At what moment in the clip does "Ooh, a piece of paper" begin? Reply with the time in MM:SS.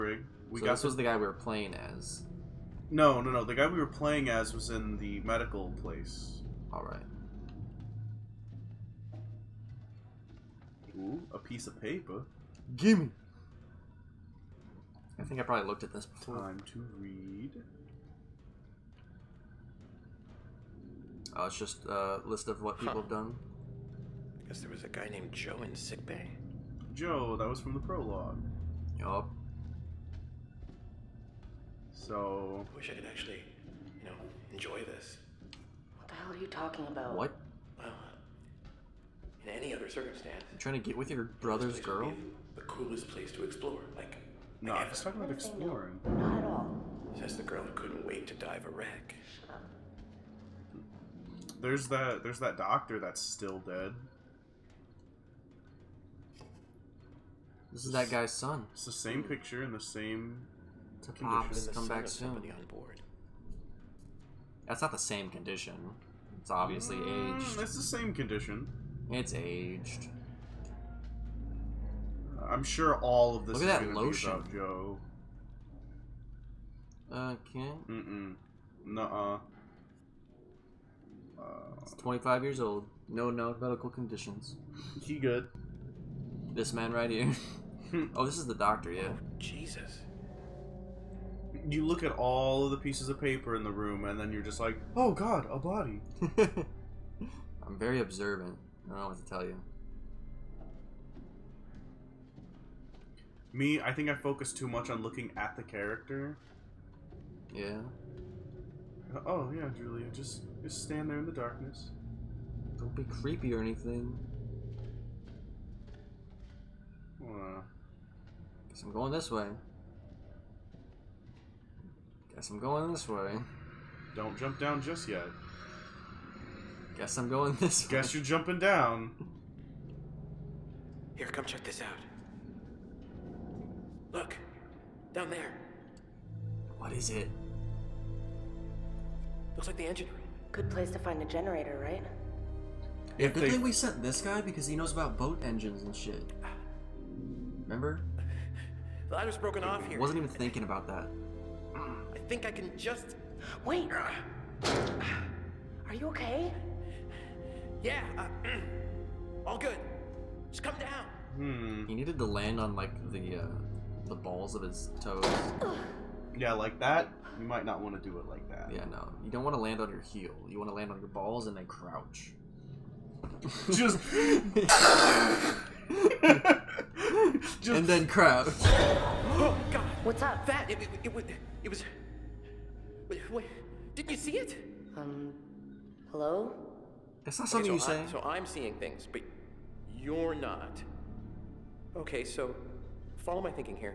00:10.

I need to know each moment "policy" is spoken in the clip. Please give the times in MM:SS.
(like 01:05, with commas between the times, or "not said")
not said.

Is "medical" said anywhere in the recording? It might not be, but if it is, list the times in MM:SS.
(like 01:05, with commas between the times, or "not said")
00:05, 01:23.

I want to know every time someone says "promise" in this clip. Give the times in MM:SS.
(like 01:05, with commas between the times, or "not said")
not said.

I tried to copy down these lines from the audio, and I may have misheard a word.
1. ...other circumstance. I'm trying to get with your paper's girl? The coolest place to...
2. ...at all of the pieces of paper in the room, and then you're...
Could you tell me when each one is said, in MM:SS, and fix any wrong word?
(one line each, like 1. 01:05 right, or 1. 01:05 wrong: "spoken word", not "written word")
1. 00:39 wrong: "brother", not "paper"
2. 01:32 right.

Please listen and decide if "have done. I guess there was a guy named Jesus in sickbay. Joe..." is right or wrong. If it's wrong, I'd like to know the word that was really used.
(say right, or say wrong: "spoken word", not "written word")
wrong: "Joe", not "Jesus".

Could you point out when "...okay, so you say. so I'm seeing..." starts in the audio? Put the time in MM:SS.
03:07.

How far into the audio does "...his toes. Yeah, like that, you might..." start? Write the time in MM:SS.
02:44.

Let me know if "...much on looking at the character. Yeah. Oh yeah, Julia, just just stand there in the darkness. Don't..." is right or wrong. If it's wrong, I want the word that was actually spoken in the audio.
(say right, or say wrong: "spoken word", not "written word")
right.